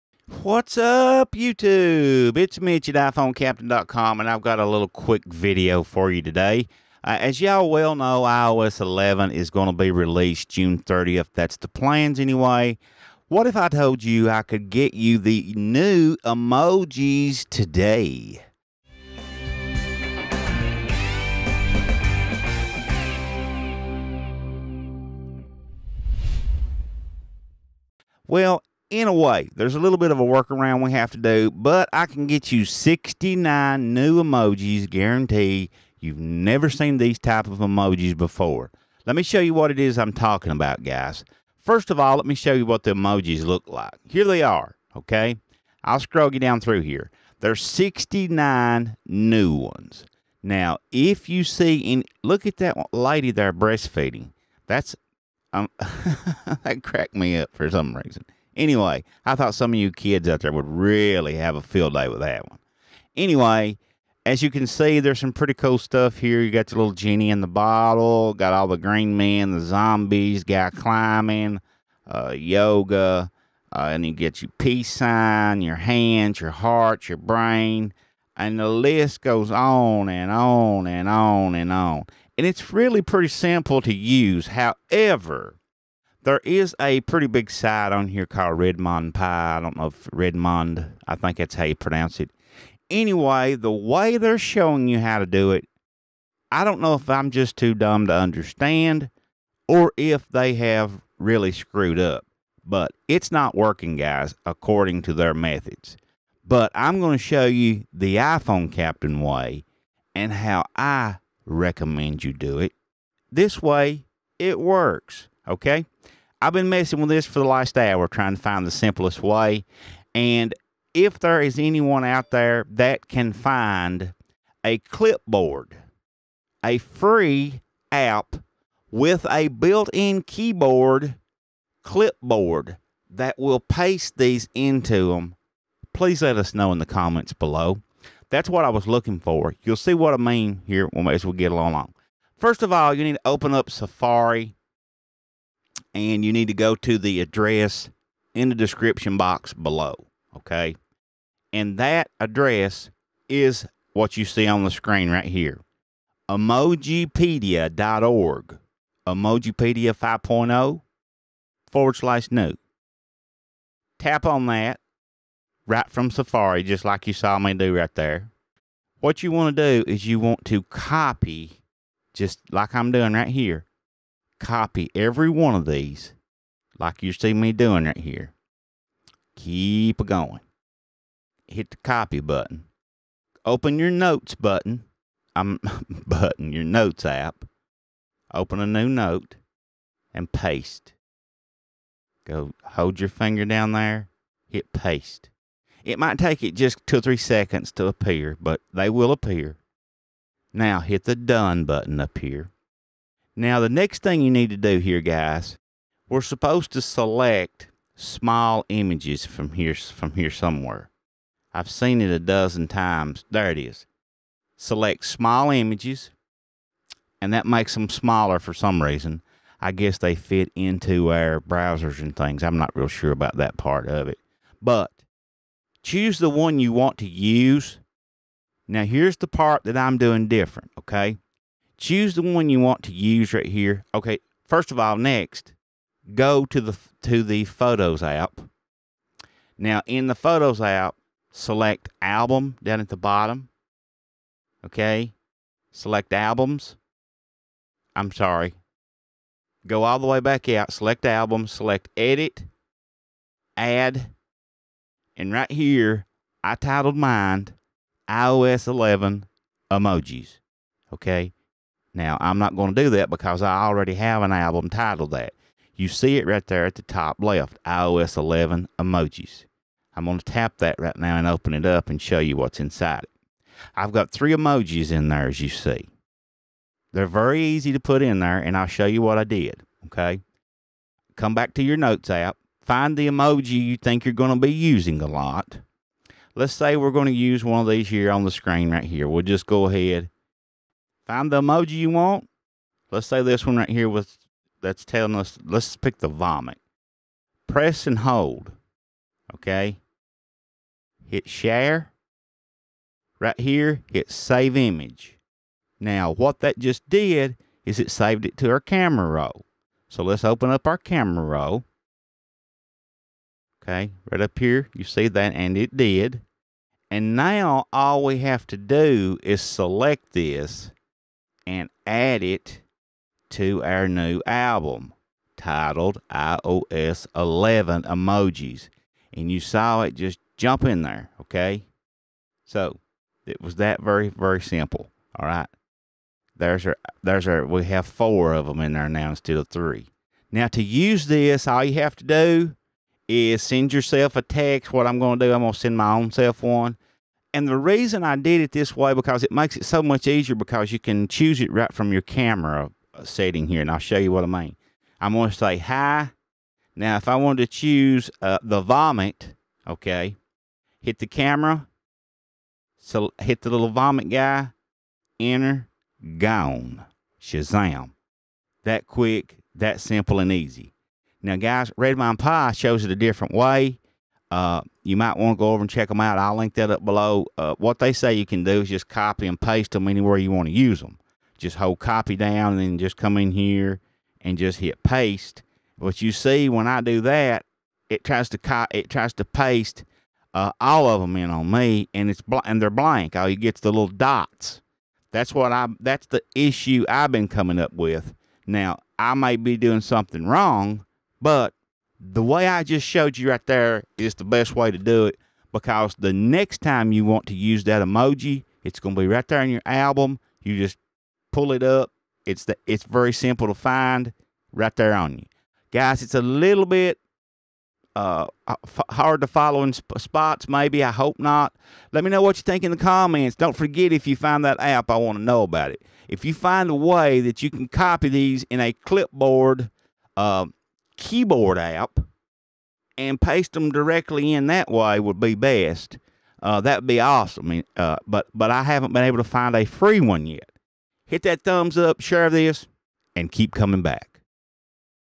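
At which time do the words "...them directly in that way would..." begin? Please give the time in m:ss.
7:13.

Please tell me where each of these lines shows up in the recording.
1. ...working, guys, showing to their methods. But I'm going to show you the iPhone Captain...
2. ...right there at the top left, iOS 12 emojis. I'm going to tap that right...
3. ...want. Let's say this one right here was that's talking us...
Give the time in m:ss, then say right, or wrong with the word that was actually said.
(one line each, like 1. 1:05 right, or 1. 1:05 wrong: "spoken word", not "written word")
1. 1:43 wrong: "according", not "showing"
2. 4:26 wrong: "11", not "12"
3. 4:51 wrong: "telling", not "talking".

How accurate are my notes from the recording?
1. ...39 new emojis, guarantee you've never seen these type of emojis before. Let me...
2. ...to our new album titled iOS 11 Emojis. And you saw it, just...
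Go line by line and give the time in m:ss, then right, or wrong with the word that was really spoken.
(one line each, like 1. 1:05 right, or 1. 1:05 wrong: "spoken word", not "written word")
1. 0:32 wrong: "69", not "39"
2. 5:23 right.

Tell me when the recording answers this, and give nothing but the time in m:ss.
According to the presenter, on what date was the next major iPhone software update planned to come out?
0:10.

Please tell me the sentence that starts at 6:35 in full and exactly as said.
That's the issue I've been coming up with.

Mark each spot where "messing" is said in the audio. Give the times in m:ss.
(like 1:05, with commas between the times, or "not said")
1:56.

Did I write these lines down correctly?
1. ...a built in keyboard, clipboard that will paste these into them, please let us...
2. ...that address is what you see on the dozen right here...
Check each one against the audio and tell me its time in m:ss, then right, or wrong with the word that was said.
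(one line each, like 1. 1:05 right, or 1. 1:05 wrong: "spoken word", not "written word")
1. 2:09 right
2. 2:31 wrong: "screen", not "dozen".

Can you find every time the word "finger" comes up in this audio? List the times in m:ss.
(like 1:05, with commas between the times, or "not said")
3:13.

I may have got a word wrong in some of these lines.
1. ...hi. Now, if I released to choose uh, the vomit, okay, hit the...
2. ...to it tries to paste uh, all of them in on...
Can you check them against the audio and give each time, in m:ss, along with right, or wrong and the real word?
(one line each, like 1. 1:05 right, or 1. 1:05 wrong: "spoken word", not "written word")
1. 5:55 wrong: "wanted", not "released"
2. 6:28 right.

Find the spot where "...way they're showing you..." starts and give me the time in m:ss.
1:33.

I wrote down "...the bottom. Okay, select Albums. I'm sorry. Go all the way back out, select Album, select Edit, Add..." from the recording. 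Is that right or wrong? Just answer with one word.
right.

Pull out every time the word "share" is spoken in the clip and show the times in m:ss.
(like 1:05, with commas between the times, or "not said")
5:01, 7:21.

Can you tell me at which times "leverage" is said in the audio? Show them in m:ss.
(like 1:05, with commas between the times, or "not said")
not said.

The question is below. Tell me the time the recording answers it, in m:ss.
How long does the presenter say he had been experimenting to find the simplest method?
1:57.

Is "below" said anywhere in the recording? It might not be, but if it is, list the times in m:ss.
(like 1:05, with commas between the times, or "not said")
2:17, 2:29, 6:16.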